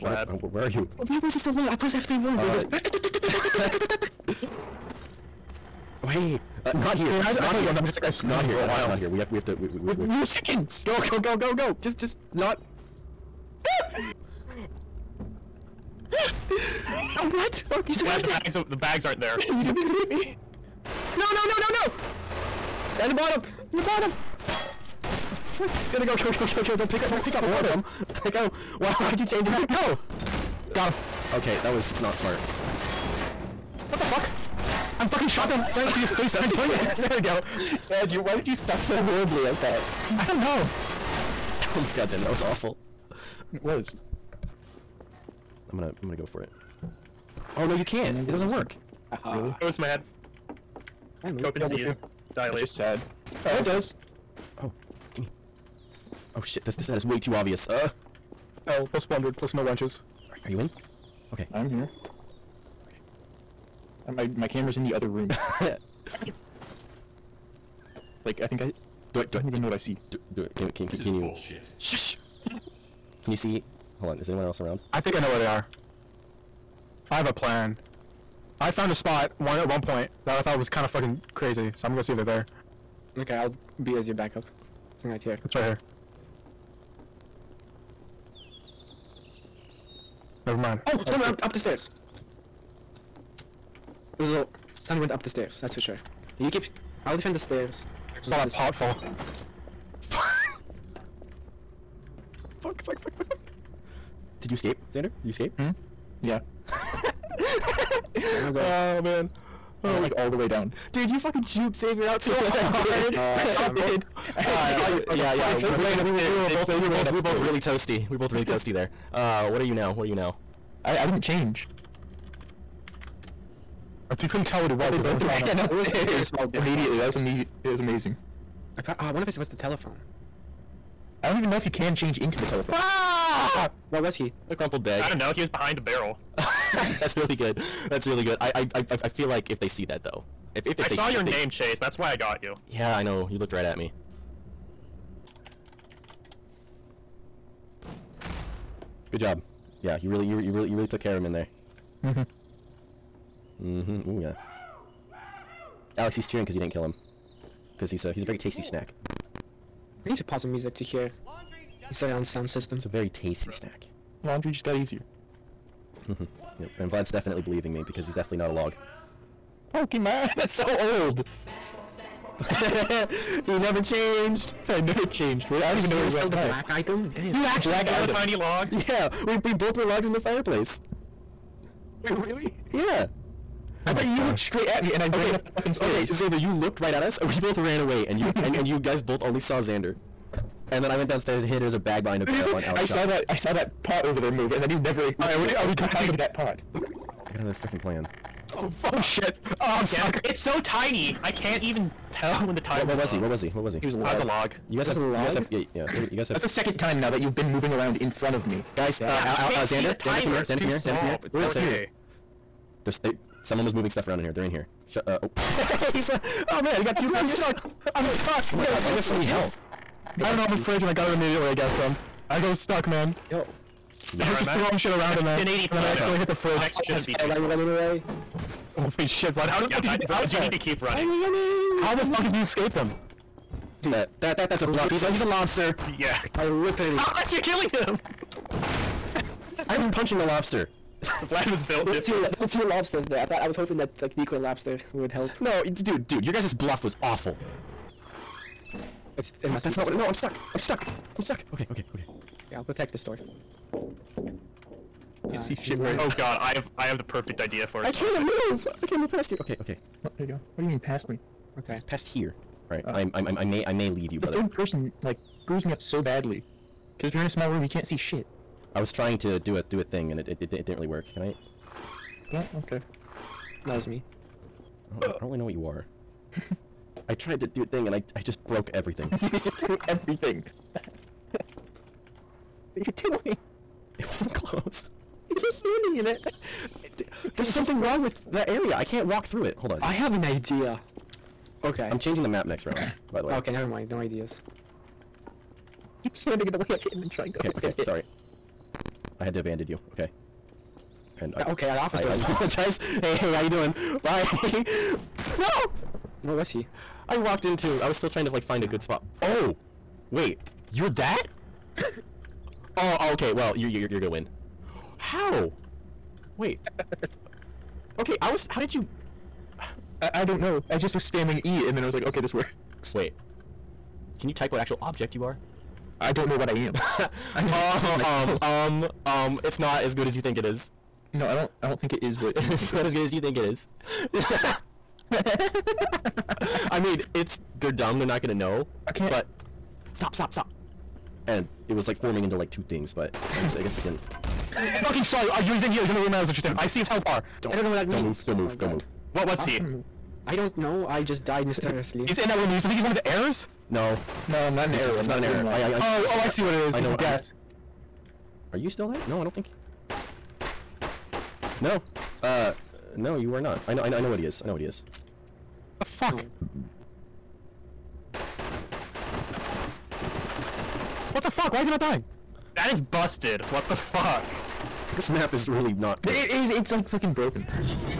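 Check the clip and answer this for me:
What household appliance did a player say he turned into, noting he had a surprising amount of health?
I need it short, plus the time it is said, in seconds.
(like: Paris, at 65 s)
A fridge, at 220 s.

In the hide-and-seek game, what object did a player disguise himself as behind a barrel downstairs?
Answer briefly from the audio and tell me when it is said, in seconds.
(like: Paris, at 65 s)
A bag, at 191 s.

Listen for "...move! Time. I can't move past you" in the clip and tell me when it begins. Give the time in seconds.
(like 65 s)
258 s.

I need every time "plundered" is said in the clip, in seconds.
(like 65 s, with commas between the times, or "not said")
59 s.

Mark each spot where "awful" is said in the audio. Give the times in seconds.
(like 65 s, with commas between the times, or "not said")
42 s, 247 s.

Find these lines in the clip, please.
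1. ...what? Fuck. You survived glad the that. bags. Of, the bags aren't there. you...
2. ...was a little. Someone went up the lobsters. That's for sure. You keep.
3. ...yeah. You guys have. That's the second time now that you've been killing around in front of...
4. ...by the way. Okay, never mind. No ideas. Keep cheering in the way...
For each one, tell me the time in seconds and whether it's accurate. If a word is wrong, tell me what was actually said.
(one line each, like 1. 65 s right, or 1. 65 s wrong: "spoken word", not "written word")
1. 17 s right
2. 94 s wrong: "stairs", not "lobsters"
3. 205 s wrong: "moving", not "killing"
4. 293 s wrong: "standing", not "cheering".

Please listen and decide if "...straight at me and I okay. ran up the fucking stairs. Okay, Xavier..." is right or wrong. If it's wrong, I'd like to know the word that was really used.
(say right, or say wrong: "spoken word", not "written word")
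right.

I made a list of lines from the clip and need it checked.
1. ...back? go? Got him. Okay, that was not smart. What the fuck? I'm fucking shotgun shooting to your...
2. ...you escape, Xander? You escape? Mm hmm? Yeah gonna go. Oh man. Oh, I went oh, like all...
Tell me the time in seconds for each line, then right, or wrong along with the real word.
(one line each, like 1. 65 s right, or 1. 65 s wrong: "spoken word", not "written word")
1. 29 s right
2. 104 s right.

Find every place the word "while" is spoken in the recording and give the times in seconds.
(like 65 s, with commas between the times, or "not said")
8 s.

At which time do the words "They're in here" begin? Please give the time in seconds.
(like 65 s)
214 s.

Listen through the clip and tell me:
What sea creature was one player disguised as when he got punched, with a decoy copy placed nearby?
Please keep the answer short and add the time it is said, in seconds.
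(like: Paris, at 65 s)
A lobster, at 234 s.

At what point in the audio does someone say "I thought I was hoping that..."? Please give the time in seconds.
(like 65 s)
243 s.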